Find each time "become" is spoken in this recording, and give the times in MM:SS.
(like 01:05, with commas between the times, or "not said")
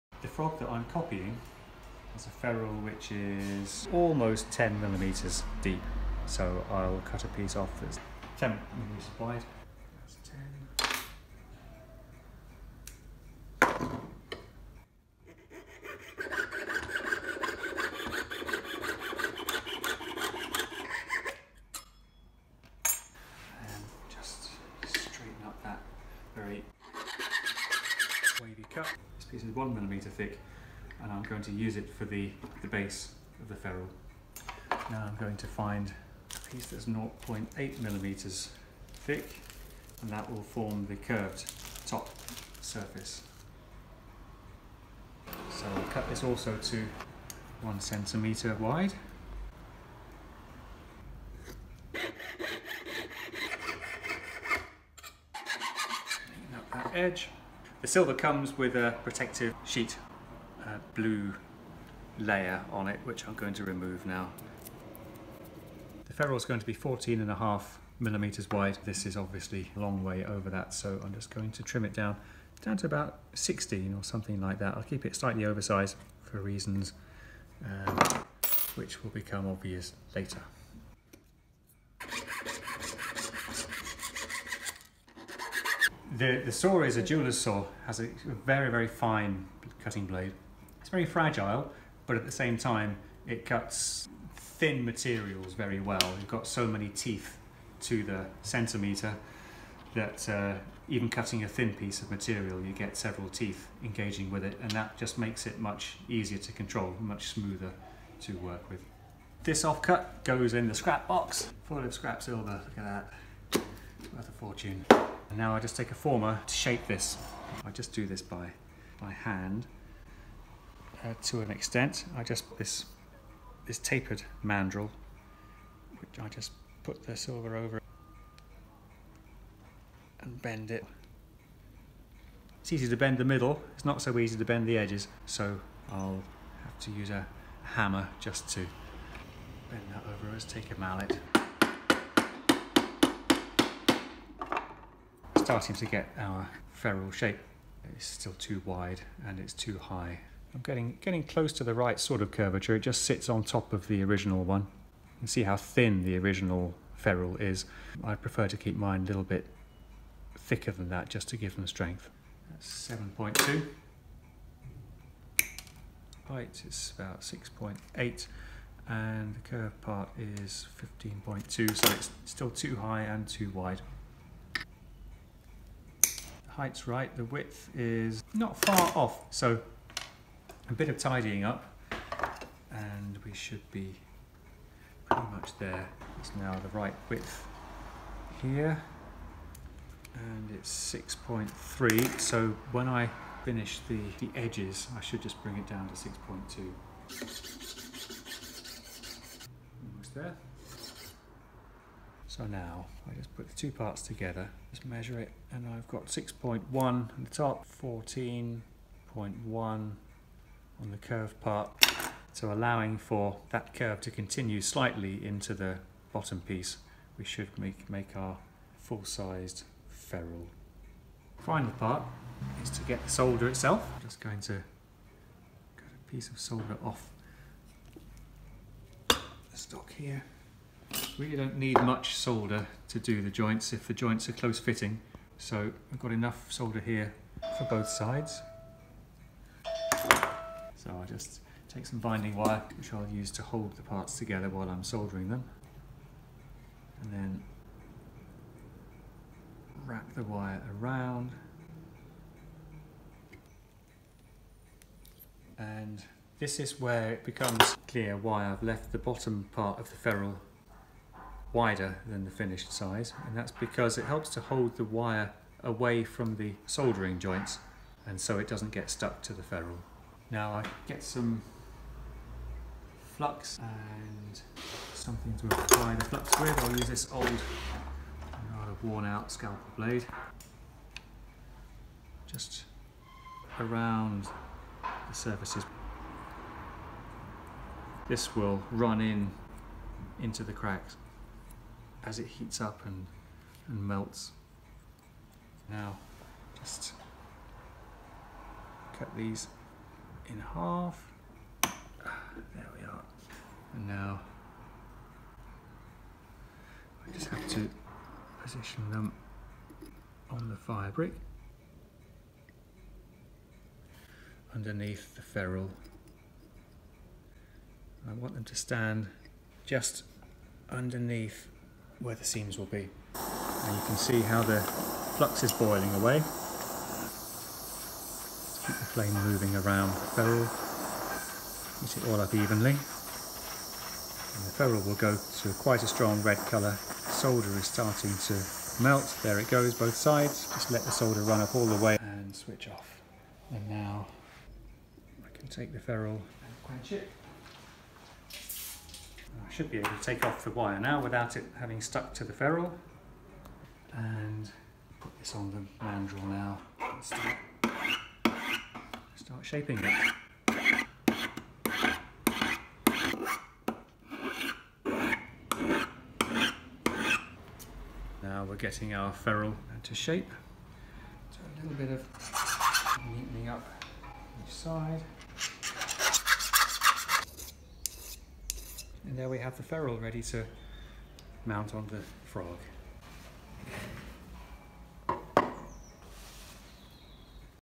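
01:19, 04:17.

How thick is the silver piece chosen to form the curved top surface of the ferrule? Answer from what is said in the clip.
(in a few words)
0.8 millimeters.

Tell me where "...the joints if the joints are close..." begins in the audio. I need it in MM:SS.
03:53.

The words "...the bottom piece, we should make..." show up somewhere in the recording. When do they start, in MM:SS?
03:35.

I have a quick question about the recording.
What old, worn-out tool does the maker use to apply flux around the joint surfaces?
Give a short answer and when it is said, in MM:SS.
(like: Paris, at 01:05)
Scalpel blade, at 04:39.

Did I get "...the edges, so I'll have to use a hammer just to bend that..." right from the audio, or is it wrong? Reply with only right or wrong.
right.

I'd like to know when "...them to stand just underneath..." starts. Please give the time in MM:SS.
05:18.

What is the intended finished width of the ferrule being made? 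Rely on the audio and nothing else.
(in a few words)
14.5 millimeters.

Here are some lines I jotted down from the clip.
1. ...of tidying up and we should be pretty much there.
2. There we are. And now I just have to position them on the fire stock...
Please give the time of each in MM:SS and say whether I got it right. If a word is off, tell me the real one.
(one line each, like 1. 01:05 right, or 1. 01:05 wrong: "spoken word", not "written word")
1. 03:00 right
2. 05:01 wrong: "brick", not "stock".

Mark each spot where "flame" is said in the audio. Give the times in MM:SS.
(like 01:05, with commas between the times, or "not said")
05:28.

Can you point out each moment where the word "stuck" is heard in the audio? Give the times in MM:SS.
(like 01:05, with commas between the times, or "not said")
04:28, 05:51.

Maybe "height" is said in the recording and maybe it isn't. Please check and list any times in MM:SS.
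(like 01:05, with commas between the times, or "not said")
02:46, 02:56.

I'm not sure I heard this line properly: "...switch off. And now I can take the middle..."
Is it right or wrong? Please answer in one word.
wrong.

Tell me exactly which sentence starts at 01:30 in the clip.
It's very fragile, but at the same time, it cuts thin materials very well.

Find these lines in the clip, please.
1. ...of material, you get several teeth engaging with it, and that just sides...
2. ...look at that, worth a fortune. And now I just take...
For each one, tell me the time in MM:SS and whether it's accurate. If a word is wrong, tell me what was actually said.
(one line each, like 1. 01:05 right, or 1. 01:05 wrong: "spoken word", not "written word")
1. 01:42 wrong: "makes", not "sides"
2. 01:52 right.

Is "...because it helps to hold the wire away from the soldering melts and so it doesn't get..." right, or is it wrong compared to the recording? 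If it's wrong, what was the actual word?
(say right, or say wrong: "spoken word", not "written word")
wrong: "joints", not "melts".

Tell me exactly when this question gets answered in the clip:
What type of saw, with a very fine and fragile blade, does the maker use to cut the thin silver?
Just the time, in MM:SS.
01:27.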